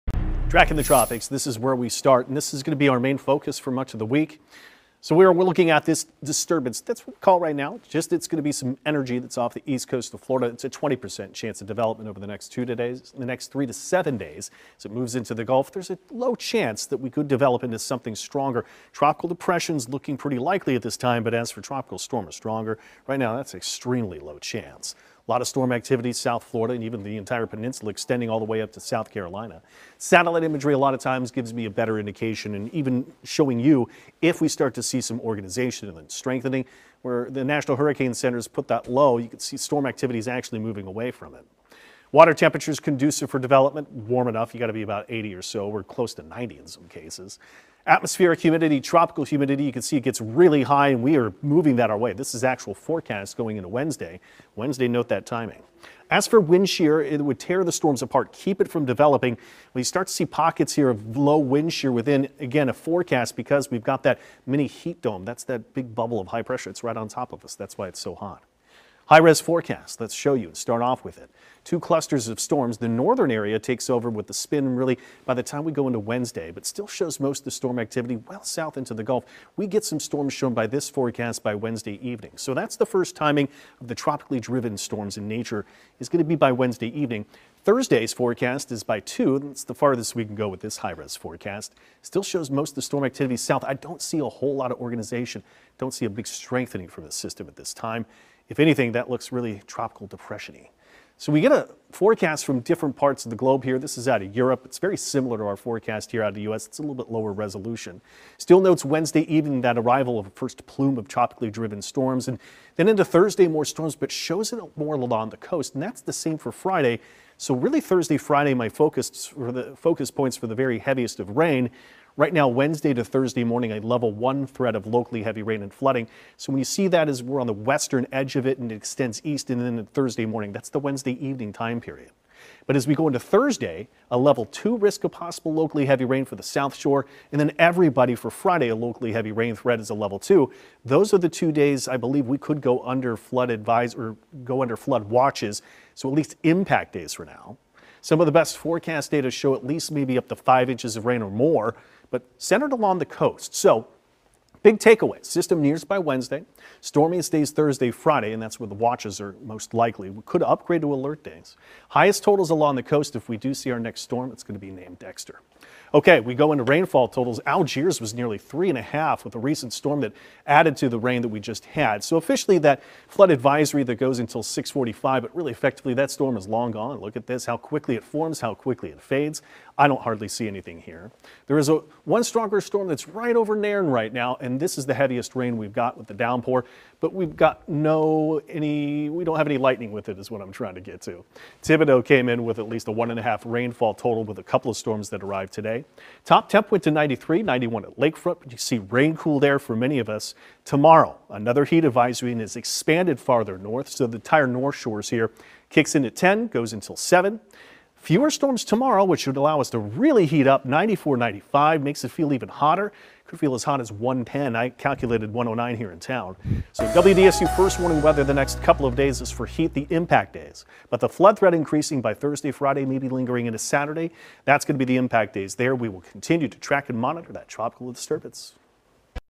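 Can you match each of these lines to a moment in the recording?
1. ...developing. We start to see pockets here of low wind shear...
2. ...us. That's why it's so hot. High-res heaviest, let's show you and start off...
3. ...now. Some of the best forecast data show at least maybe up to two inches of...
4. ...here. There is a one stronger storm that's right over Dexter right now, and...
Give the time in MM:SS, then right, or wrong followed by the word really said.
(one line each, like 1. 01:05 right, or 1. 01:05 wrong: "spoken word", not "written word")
1. 00:58 right
2. 01:07 wrong: "forecast", not "heaviest"
3. 02:27 wrong: "five", not "two"
4. 03:00 wrong: "Nairn", not "Dexter".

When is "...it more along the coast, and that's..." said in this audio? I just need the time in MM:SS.
01:54.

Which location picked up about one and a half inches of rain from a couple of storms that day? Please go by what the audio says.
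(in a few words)
Thibodaux.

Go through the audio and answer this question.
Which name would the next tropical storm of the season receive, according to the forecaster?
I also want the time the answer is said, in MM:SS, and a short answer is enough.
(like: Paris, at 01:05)
Dexter, at 02:44.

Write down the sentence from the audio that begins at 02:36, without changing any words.
Stormy stays Thursday, Friday, and that's where the watches are most likely.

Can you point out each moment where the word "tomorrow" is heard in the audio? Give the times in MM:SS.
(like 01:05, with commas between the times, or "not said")
03:20, 03:28.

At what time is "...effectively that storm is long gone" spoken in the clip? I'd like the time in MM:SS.
02:55.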